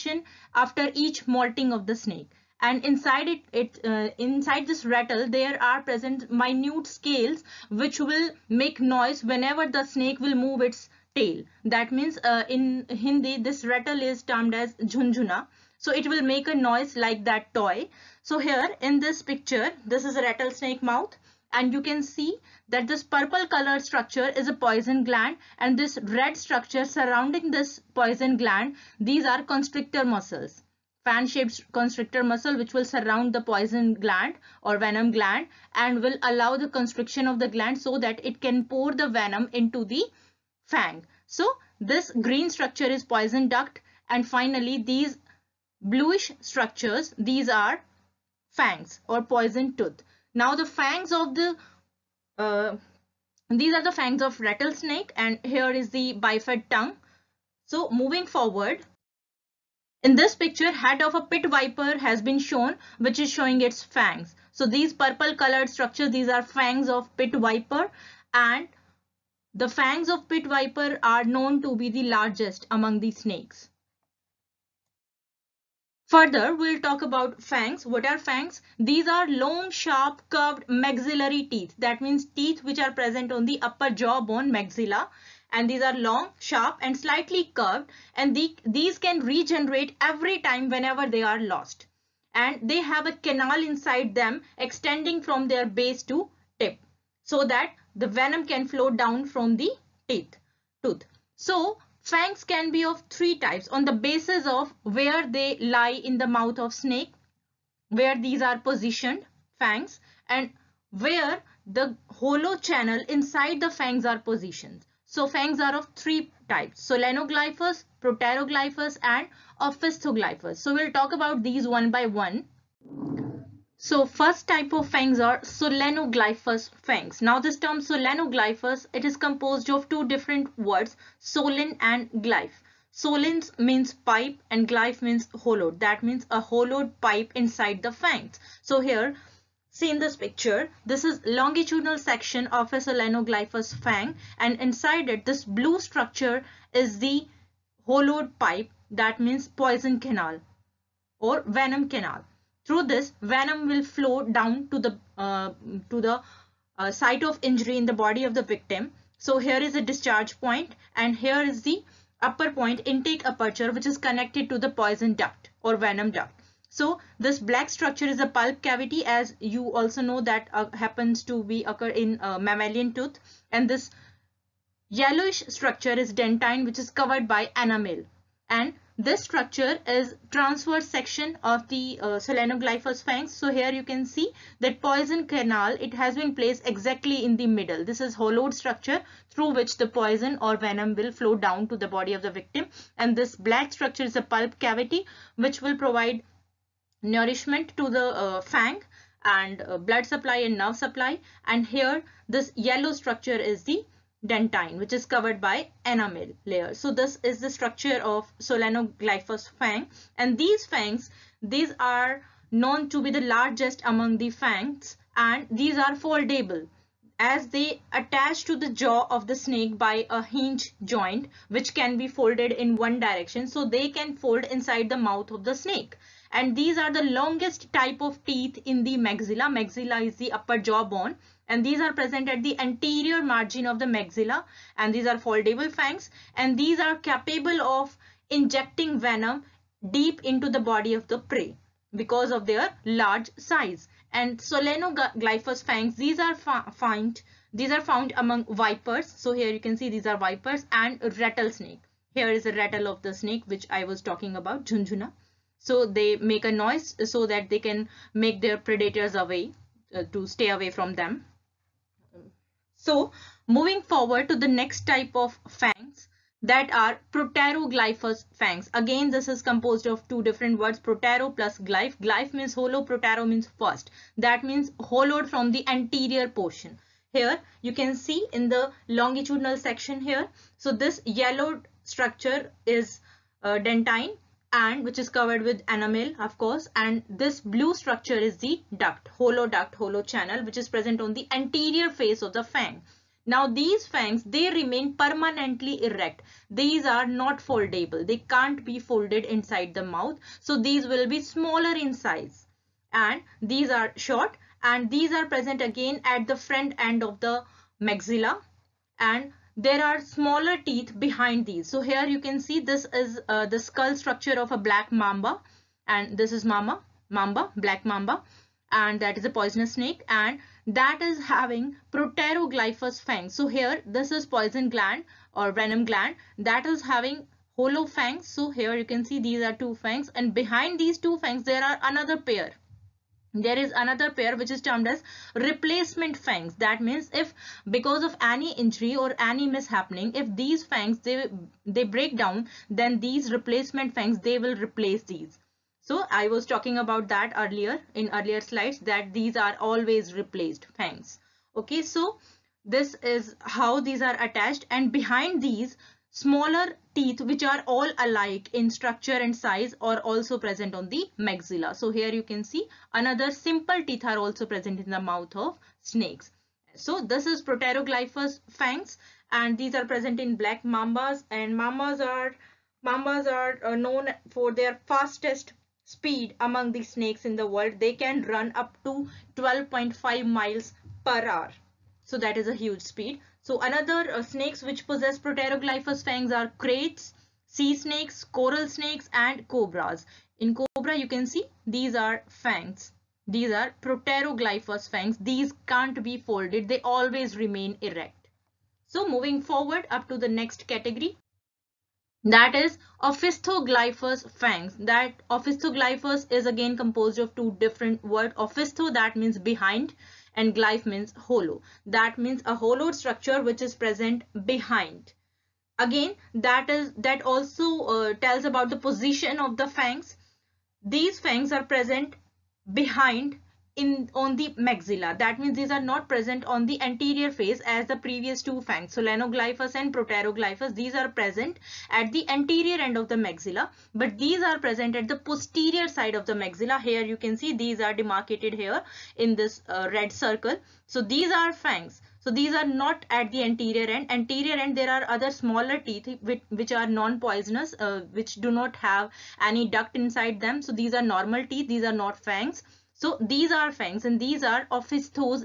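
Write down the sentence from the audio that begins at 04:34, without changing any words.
That means hollowed from the anterior portion.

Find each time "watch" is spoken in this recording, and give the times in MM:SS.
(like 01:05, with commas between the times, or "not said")
not said.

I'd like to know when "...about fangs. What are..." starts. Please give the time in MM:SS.
01:17.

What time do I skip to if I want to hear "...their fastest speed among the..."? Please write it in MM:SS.
06:14.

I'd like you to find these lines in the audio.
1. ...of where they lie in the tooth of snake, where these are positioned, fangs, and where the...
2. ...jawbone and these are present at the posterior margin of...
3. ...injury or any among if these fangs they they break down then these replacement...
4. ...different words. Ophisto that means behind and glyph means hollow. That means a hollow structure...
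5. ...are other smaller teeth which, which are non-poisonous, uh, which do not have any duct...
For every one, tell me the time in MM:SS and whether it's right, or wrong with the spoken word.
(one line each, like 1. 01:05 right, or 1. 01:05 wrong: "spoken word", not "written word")
1. 01:44 wrong: "mouth", not "tooth"
2. 03:50 wrong: "anterior", not "posterior"
3. 05:38 wrong: "mishappening", not "among"
4. 06:47 right
5. 07:24 right.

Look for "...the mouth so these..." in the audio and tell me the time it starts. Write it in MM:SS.
04:59.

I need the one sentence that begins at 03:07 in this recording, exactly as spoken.
This is hollowed structure through which the poison or venom will flow down to the body of the victim.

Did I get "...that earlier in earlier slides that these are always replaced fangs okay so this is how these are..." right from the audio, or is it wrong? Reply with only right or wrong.
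right.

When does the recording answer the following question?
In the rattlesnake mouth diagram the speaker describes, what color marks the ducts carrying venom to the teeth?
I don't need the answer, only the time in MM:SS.
00:42.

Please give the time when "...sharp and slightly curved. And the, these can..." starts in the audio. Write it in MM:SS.
01:26.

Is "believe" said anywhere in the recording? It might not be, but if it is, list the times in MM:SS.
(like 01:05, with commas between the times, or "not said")
not said.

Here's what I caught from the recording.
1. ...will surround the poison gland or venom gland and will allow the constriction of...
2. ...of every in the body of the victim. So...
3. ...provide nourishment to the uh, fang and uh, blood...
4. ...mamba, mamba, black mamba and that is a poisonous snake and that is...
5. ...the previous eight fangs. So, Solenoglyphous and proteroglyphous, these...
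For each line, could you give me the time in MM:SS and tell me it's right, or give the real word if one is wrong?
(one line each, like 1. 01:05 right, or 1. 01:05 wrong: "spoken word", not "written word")
1. 00:32 right
2. 02:37 wrong: "injury", not "every"
3. 03:15 right
4. 05:16 right
5. 07:07 wrong: "two", not "eight".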